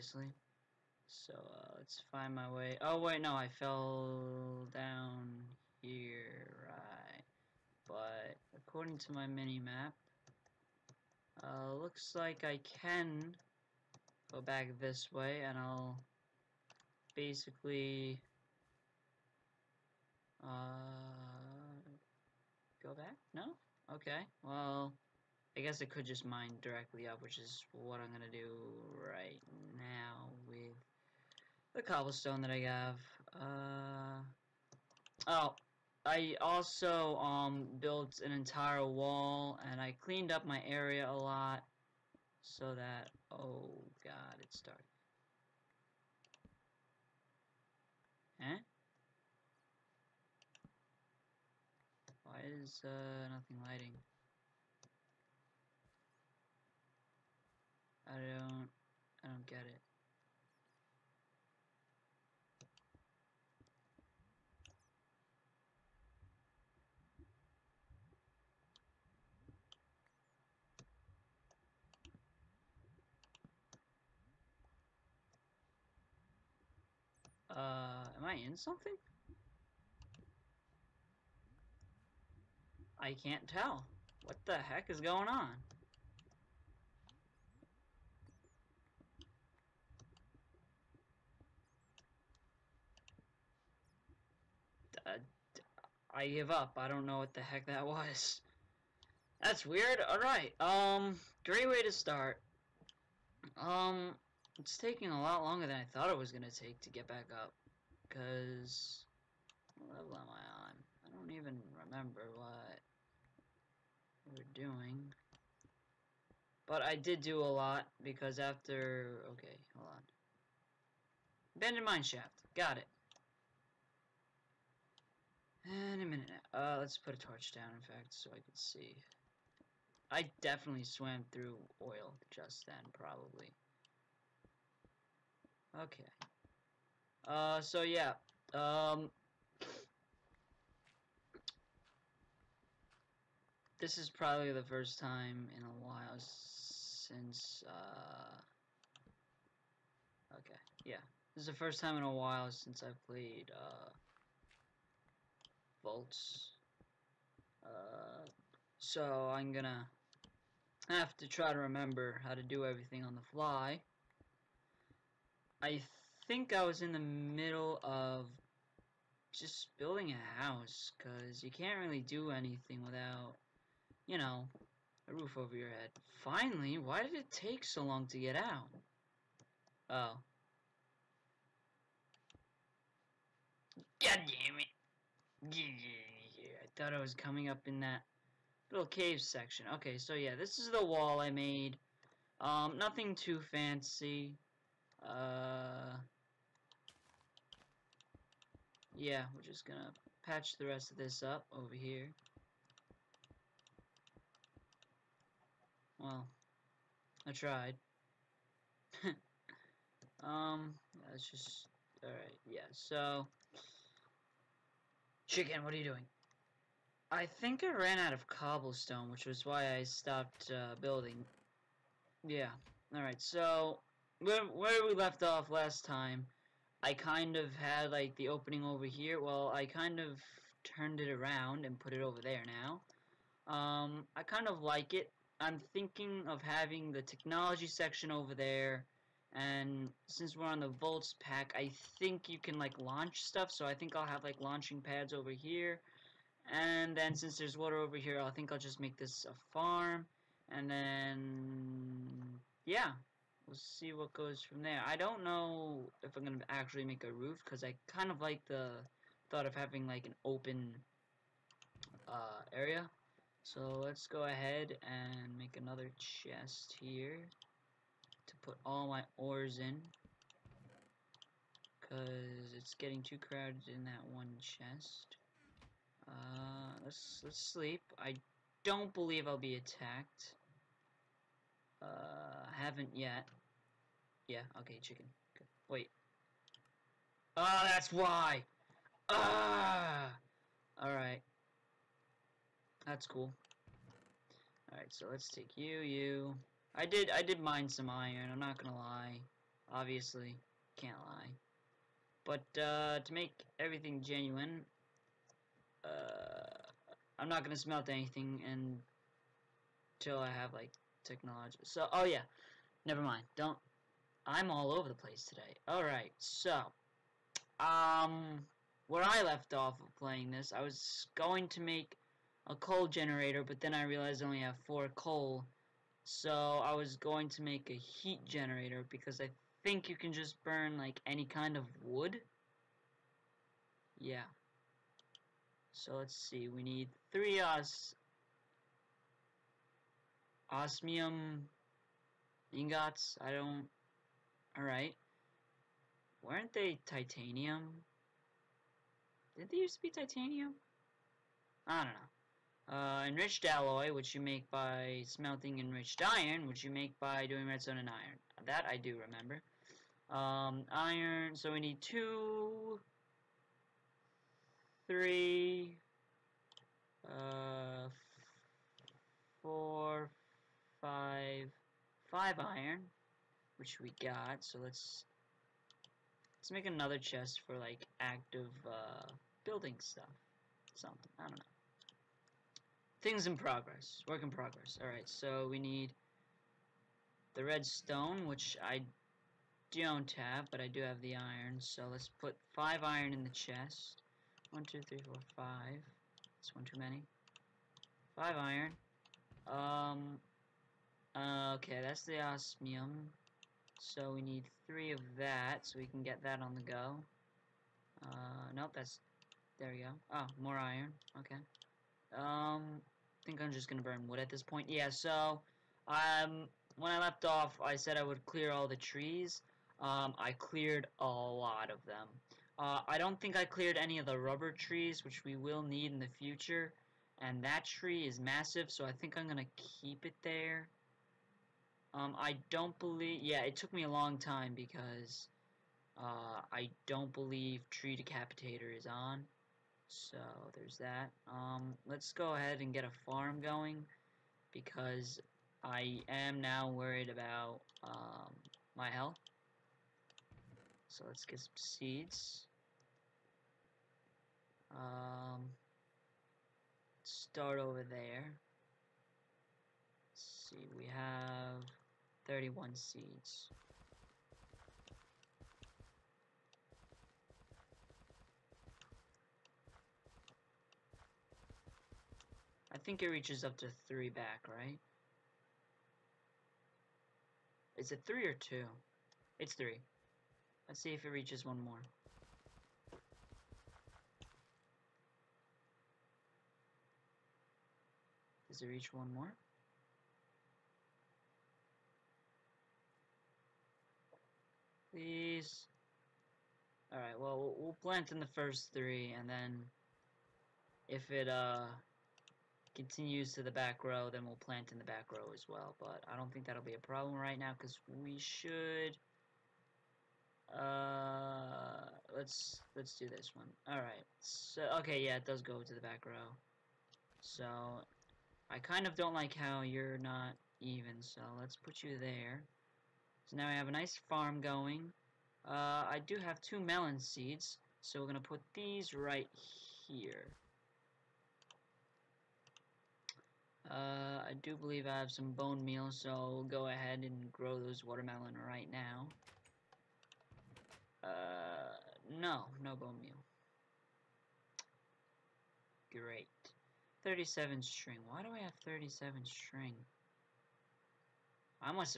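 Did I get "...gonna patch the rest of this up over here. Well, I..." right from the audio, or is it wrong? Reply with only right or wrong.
right.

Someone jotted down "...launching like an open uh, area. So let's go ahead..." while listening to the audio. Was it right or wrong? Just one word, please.
wrong.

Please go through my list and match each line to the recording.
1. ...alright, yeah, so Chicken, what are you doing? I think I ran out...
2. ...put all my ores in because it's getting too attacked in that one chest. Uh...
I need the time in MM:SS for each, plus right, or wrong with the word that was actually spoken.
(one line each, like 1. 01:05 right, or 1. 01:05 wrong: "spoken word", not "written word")
1. 03:32 right
2. 04:28 wrong: "crowded", not "attacked".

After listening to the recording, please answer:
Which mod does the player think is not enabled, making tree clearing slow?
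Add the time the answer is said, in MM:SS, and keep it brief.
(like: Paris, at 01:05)
Tree Decapitator, at 07:17.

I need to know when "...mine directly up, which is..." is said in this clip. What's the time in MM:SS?
00:26.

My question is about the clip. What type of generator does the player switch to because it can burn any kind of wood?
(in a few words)
Heat generator.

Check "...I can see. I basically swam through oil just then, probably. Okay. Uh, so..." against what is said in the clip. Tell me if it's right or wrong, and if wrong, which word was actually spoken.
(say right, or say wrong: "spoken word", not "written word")
wrong: "definitely", not "basically".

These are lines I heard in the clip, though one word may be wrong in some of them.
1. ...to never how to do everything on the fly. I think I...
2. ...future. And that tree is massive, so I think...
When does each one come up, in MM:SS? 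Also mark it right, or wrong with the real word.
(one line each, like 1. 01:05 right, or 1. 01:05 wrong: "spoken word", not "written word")
1. 02:41 wrong: "remember", not "never"
2. 07:06 right.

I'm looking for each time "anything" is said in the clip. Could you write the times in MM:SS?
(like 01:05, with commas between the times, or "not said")
02:52, 05:07.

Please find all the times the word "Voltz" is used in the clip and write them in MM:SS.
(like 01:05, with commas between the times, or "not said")
02:35, 04:00.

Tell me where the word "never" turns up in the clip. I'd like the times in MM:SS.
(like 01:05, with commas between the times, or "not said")
05:12.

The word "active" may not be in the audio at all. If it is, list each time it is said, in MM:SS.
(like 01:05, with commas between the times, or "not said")
06:18.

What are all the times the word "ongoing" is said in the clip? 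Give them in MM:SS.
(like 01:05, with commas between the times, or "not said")
not said.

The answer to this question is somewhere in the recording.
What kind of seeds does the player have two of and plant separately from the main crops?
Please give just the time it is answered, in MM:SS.
08:46.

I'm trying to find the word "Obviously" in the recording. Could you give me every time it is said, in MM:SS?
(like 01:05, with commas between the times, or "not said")
04:59.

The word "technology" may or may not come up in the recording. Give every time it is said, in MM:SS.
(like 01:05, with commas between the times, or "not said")
03:57, 05:11.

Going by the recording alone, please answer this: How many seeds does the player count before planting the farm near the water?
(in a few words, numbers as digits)
31.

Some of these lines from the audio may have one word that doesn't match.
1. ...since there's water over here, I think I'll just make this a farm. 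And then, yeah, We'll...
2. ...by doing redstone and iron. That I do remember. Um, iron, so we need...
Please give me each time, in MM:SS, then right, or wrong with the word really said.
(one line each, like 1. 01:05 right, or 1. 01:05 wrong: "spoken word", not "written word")
1. 04:07 right
2. 05:57 right.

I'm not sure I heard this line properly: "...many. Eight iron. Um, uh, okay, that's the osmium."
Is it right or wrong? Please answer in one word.
wrong.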